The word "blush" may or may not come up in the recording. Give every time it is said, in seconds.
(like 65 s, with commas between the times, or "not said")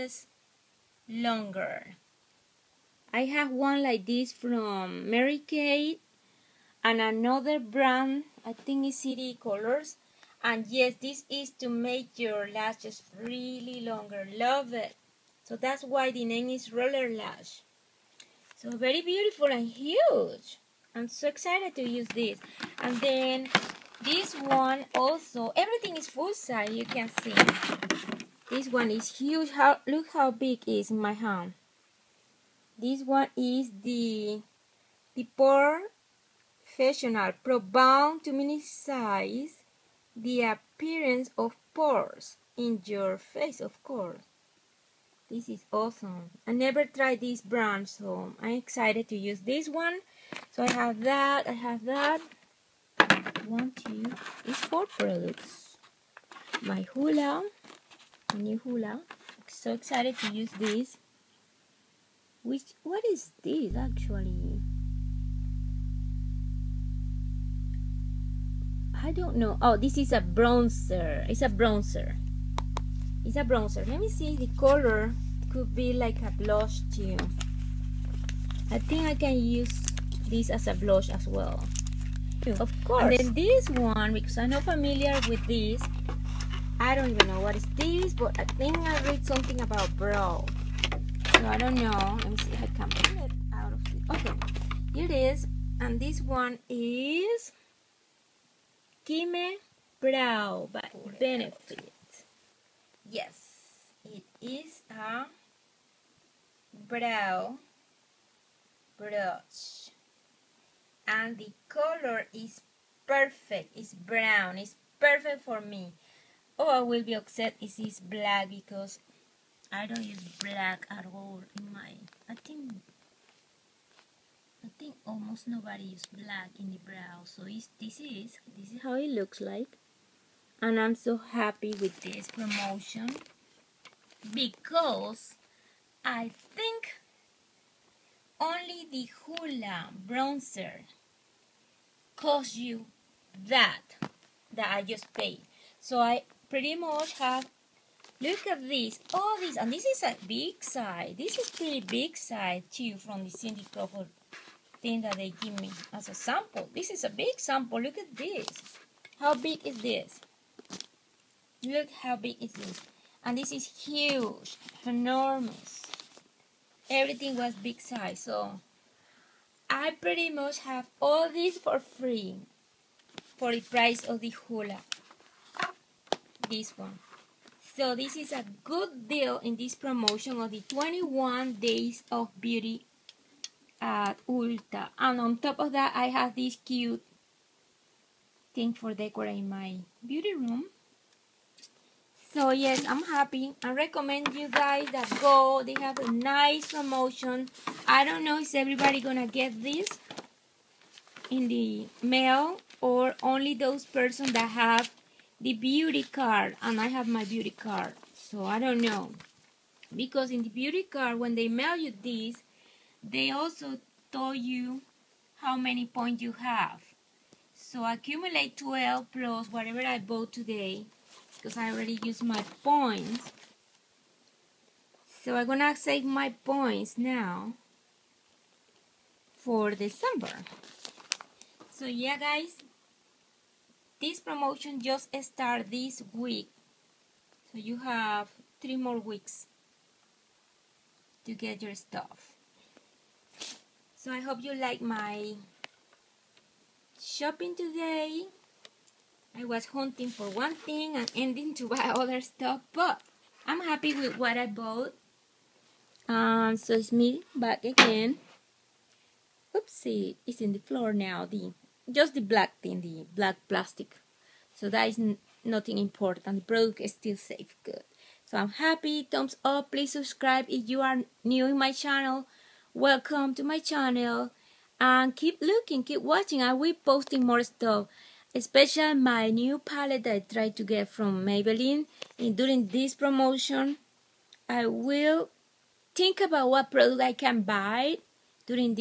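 76 s, 80 s.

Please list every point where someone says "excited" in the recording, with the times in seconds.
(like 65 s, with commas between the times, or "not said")
21 s, 48 s, 59 s.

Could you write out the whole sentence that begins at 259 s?
Oopsie, it's in the floor now.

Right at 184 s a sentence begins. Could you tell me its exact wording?
And on top of that, I have this cute thing for decorating my beauty room.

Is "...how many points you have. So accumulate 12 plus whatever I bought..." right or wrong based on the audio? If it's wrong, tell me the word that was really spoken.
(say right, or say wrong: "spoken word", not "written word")
right.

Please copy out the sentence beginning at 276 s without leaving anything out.
I will posting more stuff, especially my new palette I tried to get from Maybelline.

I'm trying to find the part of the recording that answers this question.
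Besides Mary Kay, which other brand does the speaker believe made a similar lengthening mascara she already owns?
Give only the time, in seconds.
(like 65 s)
9 s.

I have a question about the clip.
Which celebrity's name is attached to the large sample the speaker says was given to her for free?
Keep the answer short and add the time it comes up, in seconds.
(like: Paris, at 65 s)
Cindy Crawford, at 153 s.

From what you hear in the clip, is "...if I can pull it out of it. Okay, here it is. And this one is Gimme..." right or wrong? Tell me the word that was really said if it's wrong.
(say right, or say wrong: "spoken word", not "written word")
right.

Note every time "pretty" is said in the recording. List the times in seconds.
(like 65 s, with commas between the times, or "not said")
146 s, 151 s, 169 s.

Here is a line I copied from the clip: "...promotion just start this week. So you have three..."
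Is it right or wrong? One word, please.
right.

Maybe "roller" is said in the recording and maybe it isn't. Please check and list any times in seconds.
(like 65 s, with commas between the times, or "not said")
16 s.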